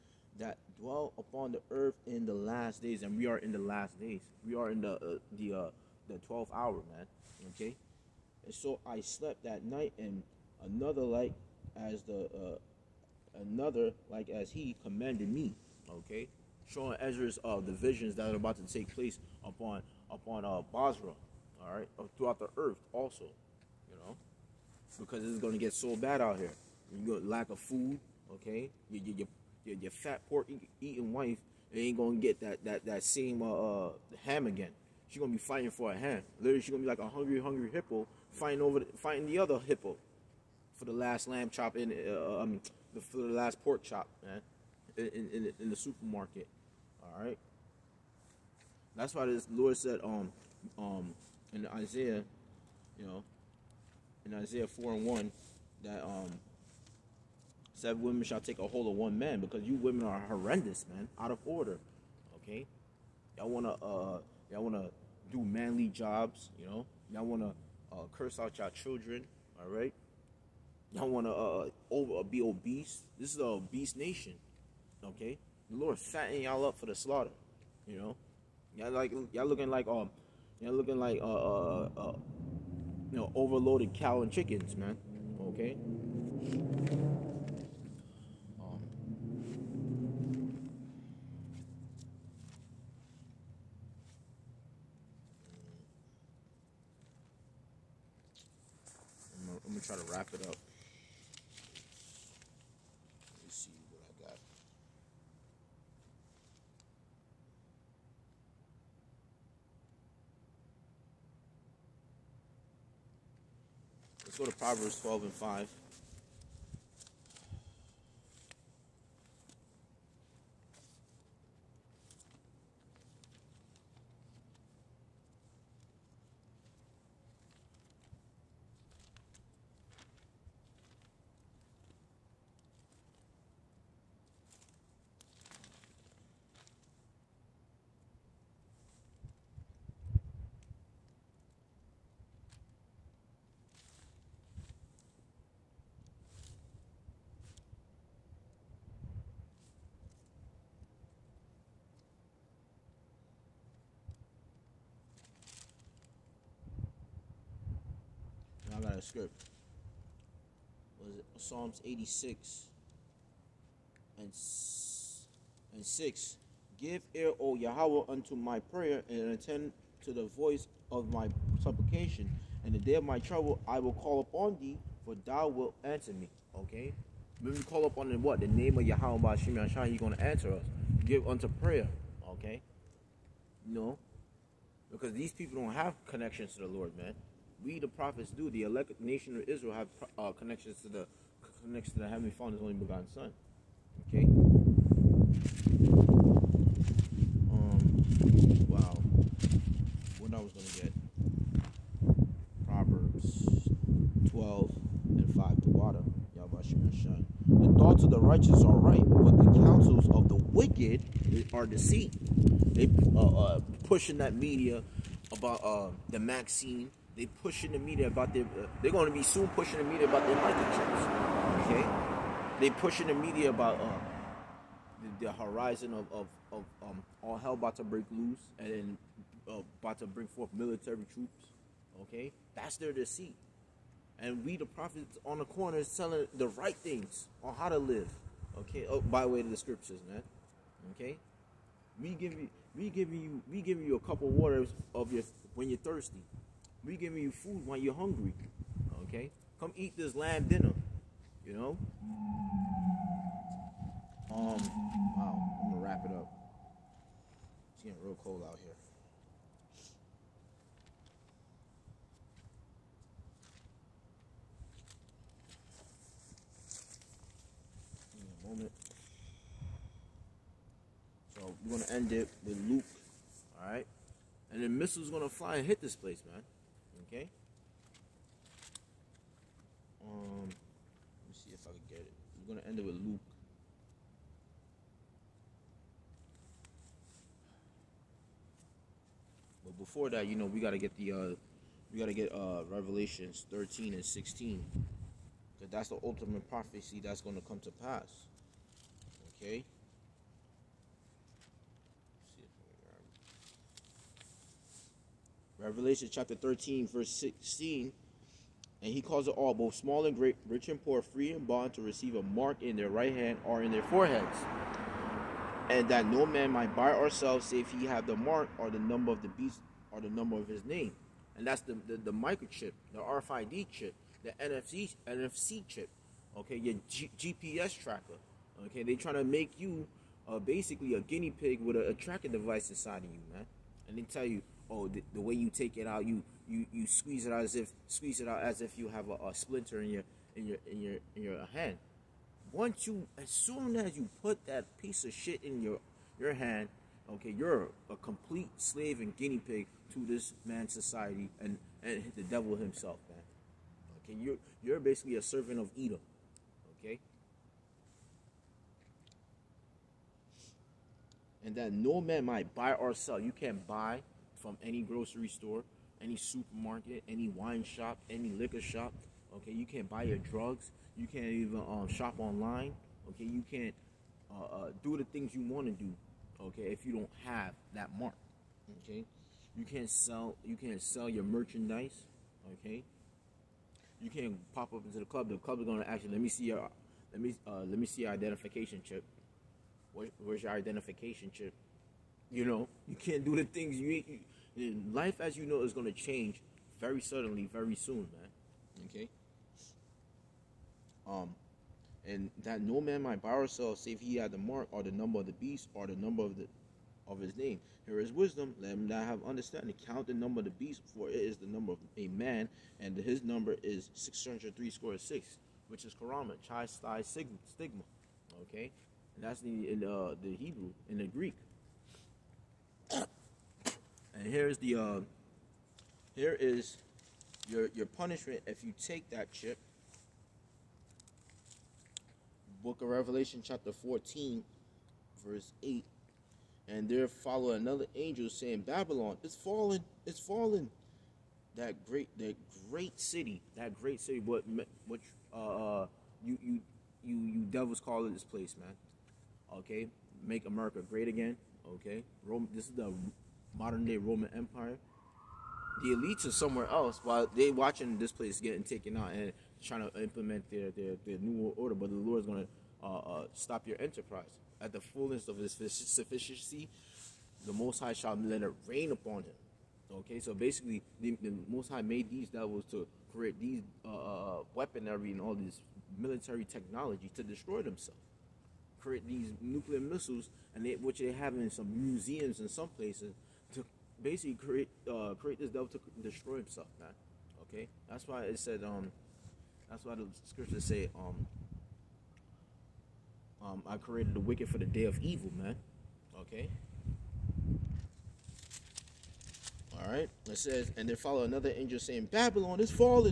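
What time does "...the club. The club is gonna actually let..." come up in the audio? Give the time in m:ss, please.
6:25.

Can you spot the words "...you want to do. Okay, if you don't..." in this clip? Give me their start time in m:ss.
6:15.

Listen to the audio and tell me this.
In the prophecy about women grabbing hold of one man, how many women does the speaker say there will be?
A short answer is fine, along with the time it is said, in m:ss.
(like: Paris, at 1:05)
7, at 0:57.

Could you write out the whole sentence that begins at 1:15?
The Lord fatten y'all up for the slaughter, you know.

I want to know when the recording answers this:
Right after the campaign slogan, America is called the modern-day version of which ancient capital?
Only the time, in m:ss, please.
7:32.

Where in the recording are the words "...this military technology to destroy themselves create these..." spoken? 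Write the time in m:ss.
7:55.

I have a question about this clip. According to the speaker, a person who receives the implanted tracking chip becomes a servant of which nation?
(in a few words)
Edom.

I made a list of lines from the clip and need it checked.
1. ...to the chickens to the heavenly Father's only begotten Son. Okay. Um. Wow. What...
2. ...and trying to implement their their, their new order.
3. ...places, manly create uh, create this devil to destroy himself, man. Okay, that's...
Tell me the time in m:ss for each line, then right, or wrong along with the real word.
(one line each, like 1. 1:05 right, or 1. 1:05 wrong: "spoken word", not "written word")
1. 3:10 wrong: "connections", not "chickens"
2. 7:39 right
3. 8:02 wrong: "basically", not "manly".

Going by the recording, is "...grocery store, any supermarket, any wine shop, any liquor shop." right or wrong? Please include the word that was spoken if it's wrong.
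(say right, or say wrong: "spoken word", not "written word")
right.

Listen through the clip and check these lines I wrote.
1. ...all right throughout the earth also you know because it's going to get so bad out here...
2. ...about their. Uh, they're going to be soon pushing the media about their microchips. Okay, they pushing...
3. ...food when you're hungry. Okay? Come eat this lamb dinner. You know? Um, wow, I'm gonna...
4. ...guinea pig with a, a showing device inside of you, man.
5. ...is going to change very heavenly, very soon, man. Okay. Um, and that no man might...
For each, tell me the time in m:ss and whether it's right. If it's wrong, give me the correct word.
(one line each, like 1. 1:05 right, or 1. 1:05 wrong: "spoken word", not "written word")
1. 0:21 right
2. 3:38 right
3. 4:07 right
4. 5:31 wrong: "tracking", not "showing"
5. 6:35 wrong: "suddenly", not "heavenly".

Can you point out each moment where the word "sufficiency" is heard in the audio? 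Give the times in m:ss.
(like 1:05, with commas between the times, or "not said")
7:45.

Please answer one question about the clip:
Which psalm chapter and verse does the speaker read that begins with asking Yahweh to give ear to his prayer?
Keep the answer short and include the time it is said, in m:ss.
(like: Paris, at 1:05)
Psalms 86:6, at 2:41.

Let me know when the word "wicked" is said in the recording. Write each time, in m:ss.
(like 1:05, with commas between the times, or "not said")
3:30, 8:14.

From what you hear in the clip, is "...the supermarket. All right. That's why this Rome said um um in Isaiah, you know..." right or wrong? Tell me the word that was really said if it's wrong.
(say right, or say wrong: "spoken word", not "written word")
wrong: "Lord", not "Rome".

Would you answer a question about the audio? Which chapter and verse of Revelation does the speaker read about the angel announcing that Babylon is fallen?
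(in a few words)
Revelation 14:8.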